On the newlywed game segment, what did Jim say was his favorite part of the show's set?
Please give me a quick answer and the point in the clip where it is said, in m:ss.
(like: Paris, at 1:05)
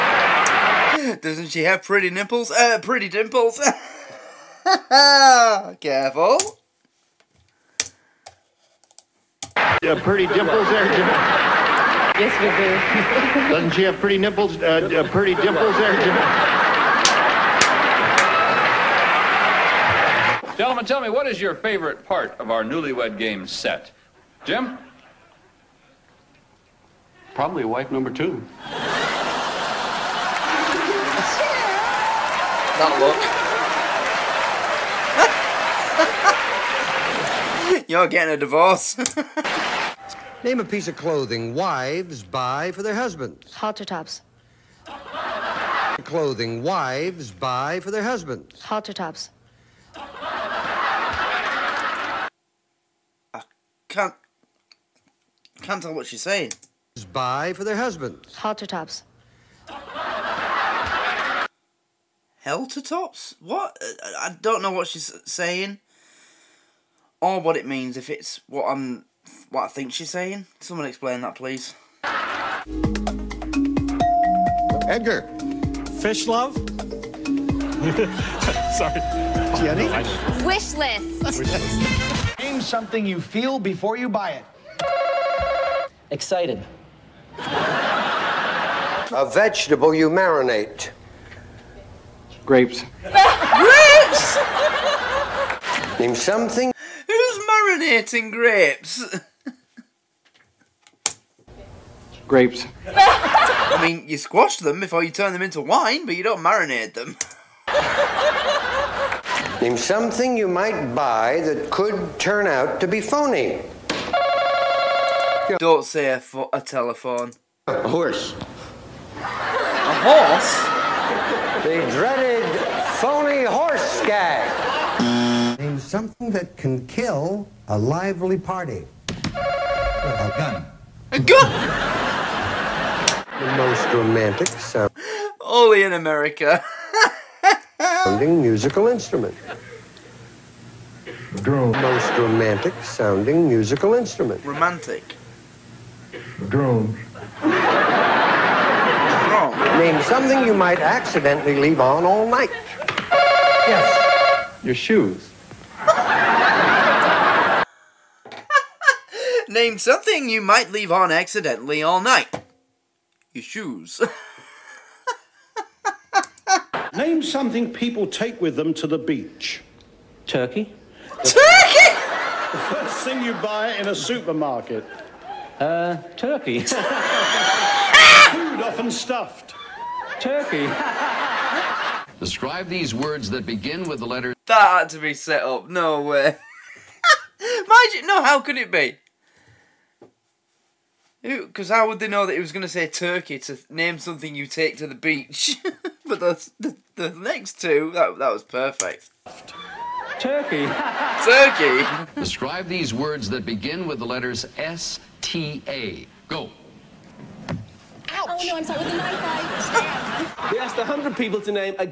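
Wife number two, at 0:27.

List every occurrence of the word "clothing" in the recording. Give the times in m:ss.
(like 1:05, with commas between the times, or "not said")
0:40, 0:46.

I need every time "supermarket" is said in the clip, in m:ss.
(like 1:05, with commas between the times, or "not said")
2:53.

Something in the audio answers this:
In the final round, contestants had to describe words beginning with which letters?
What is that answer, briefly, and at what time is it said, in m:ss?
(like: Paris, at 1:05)
S, T, A, at 3:24.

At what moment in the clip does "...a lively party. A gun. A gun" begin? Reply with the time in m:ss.
2:07.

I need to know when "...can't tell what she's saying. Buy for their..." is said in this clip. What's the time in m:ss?
0:55.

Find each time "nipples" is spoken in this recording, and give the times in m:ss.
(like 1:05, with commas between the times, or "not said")
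0:02, 0:14.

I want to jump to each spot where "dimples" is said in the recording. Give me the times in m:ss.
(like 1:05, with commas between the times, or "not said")
0:03, 0:10, 0:15.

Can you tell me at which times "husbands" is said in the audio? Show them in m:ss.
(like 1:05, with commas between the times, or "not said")
0:42, 0:48, 0:57.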